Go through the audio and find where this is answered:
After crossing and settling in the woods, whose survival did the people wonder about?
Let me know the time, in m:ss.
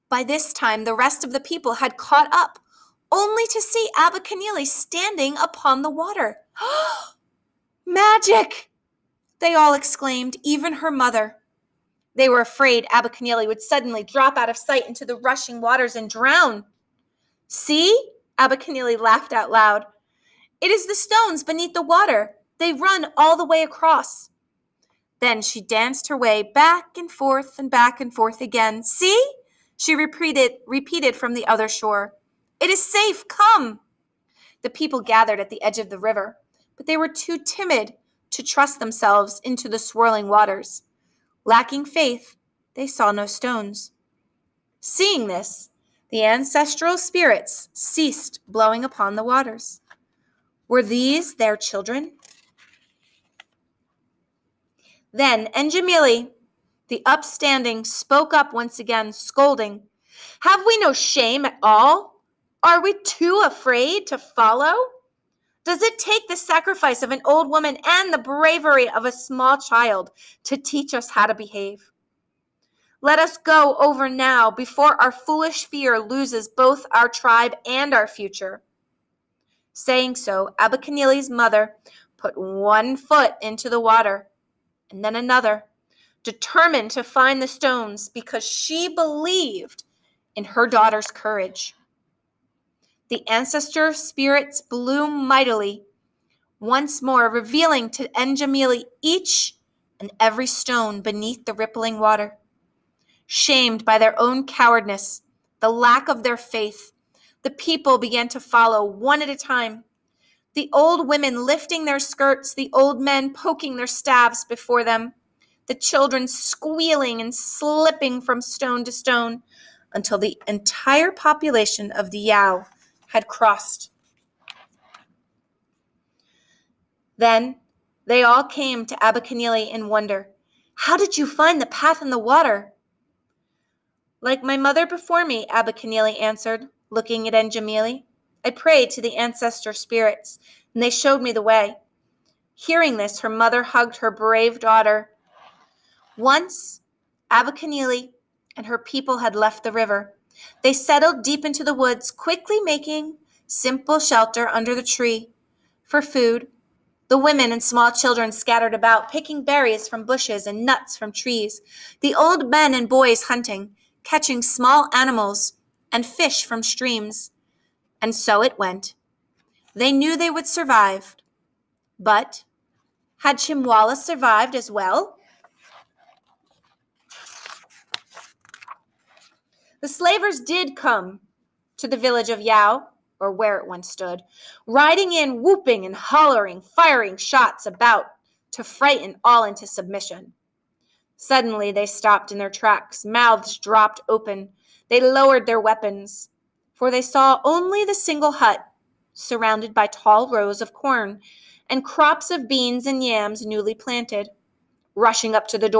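2:53.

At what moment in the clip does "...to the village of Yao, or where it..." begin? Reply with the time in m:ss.
3:01.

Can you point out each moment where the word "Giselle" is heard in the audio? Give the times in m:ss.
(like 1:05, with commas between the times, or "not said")
not said.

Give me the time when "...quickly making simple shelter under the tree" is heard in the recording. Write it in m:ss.
2:32.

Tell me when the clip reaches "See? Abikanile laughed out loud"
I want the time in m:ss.
0:17.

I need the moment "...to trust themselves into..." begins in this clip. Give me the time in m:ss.
0:38.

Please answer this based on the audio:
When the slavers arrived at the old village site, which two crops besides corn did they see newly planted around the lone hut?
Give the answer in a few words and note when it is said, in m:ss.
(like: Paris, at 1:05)
Beans and yams, at 3:22.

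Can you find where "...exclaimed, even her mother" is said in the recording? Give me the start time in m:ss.
0:09.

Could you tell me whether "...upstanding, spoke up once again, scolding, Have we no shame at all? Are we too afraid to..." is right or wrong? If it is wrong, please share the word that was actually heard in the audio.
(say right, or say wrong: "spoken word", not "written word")
right.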